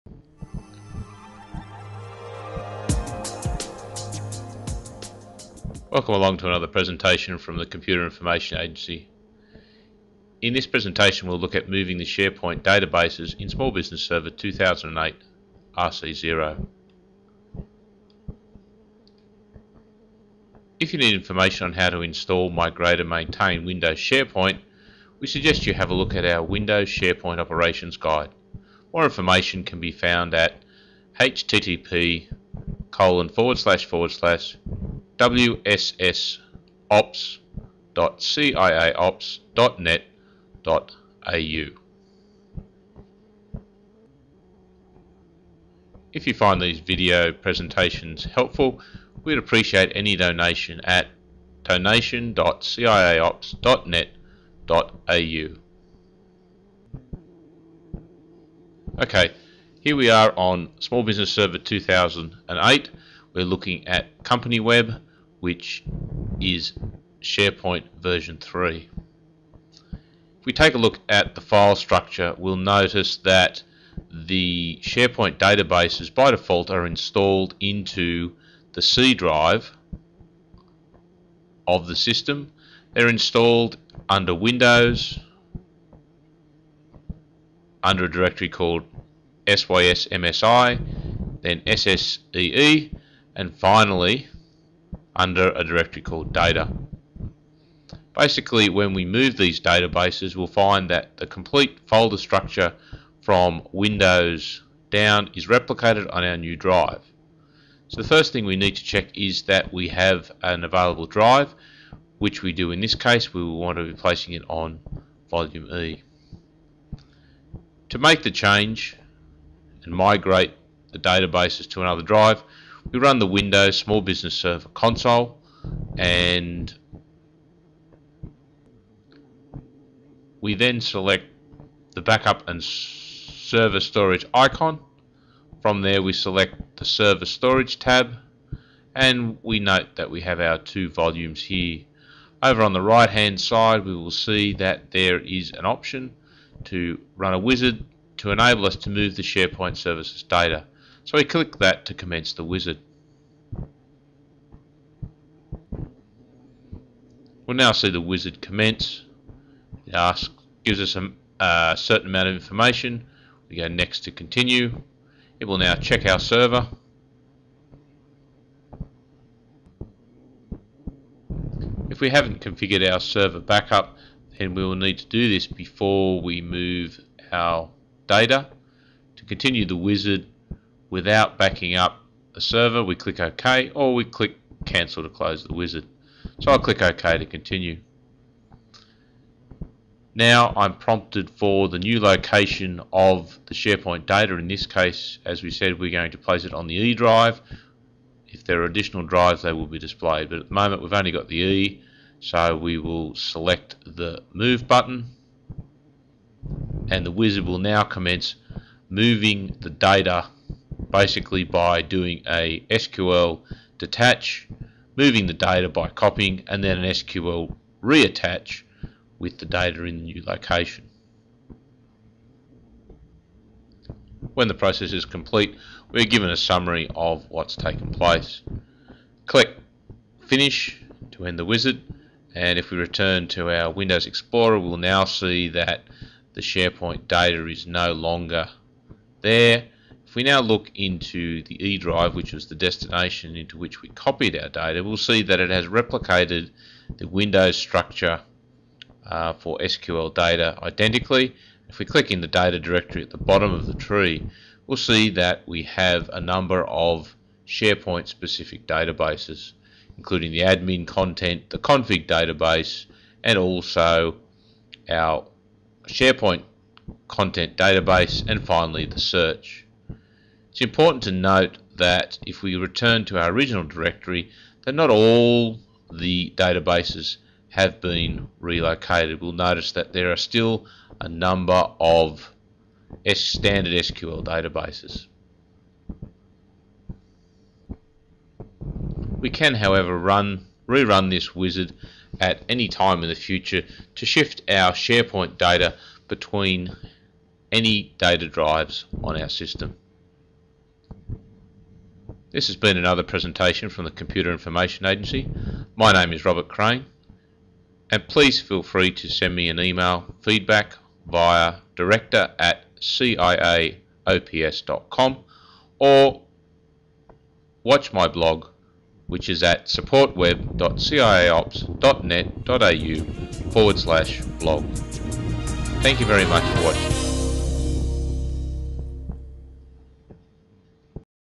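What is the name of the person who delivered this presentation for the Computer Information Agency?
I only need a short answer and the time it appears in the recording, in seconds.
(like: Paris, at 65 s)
Robert Crane, at 306 s.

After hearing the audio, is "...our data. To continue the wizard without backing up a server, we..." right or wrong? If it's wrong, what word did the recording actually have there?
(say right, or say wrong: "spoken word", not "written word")
right.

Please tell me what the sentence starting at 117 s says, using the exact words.
To make the change, and migrate the databases to another drive.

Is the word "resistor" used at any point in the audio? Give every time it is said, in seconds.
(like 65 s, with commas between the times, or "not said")
not said.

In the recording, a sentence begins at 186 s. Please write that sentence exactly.
So I'll click OK to continue.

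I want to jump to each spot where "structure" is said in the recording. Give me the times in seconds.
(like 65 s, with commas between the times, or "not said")
71 s, 102 s, 247 s.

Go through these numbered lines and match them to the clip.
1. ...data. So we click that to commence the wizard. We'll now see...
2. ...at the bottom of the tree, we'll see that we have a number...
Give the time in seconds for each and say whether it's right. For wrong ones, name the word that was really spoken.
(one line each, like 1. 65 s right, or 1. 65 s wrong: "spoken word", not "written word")
1. 150 s right
2. 253 s right.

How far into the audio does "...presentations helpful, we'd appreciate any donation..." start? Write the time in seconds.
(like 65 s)
47 s.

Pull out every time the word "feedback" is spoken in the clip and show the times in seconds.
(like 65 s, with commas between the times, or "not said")
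310 s.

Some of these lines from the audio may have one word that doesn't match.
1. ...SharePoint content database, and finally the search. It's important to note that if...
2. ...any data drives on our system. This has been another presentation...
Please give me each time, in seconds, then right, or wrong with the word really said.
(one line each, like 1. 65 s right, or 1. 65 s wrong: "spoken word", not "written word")
1. 265 s right
2. 297 s right.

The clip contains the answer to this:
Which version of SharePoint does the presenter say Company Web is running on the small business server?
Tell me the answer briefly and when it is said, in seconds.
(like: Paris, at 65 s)
version 3, at 67 s.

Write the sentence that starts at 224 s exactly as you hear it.
When the process is complete, we're given a summary of what's taken place.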